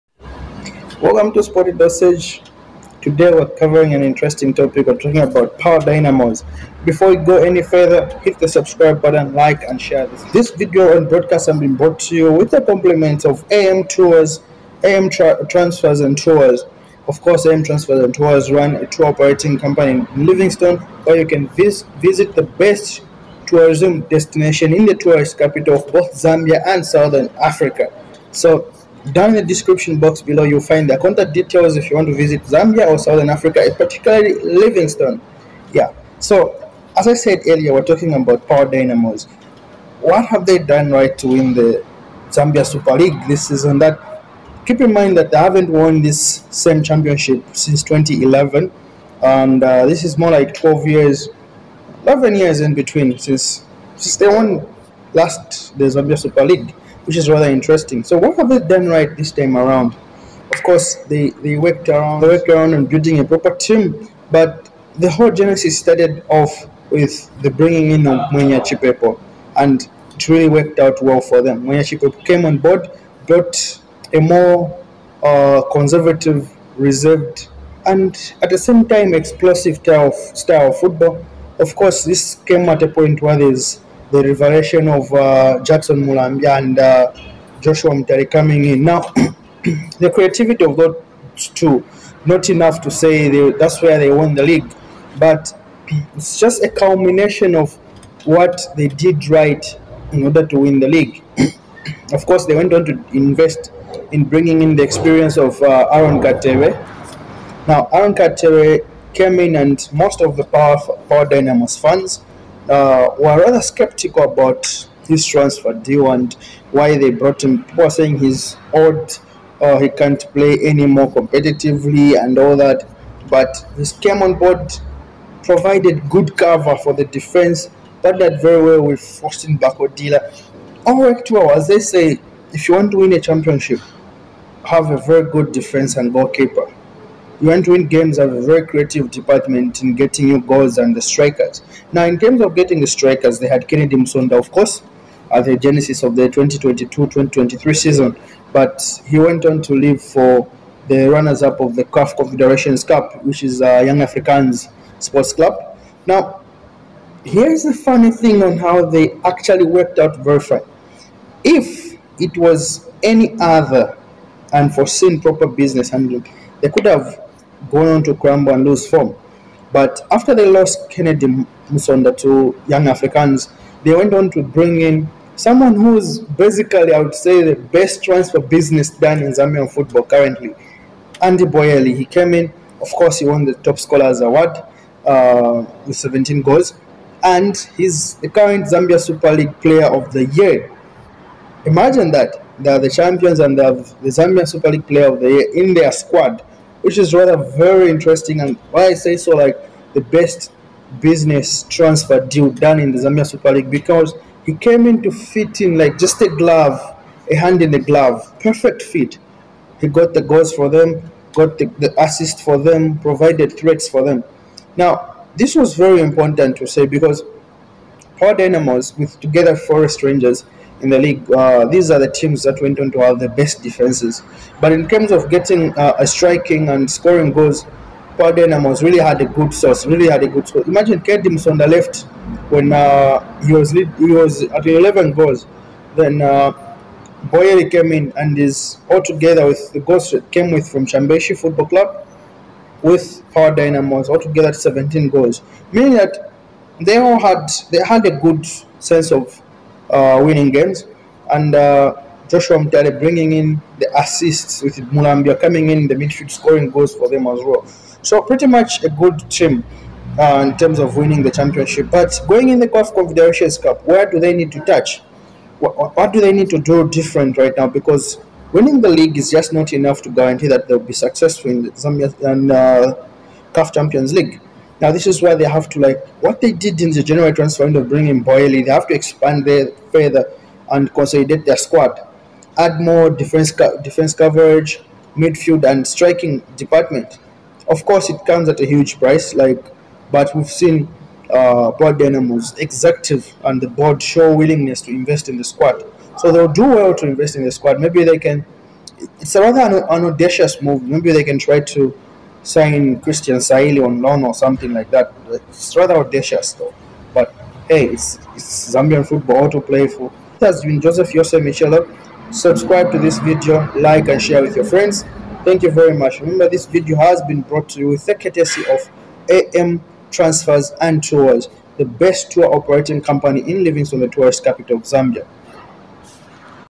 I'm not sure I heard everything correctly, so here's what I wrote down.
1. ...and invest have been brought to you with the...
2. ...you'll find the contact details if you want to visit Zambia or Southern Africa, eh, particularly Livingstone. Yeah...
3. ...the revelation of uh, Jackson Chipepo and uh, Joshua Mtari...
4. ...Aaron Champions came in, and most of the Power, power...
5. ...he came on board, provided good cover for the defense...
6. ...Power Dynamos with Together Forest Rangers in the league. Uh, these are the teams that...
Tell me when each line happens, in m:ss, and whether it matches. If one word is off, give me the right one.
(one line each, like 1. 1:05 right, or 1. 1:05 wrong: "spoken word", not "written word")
1. 0:10 wrong: "broadcast", not "invest"
2. 0:30 right
3. 1:24 wrong: "Mulambia", not "Chipepo"
4. 1:47 wrong: "Katewe", not "Champions"
5. 2:03 right
6. 3:38 right.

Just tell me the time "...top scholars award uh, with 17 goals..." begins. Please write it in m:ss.
3:03.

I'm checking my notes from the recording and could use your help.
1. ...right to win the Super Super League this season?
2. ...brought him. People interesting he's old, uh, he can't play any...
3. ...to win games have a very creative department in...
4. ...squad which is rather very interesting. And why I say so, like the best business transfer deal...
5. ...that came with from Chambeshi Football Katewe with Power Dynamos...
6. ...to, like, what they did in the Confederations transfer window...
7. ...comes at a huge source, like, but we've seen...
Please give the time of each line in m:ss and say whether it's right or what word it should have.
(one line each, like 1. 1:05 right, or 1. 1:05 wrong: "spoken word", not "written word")
1. 0:40 wrong: "Zambia", not "Super"
2. 1:57 wrong: "saying", not "interesting"
3. 2:17 right
4. 3:15 right
5. 4:00 wrong: "Club", not "Katewe"
6. 4:35 wrong: "January", not "Confederations"
7. 4:48 wrong: "price", not "source".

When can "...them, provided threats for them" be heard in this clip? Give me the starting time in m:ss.
3:32.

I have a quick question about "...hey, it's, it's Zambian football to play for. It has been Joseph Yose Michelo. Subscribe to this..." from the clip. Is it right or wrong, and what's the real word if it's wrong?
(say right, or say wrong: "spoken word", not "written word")
right.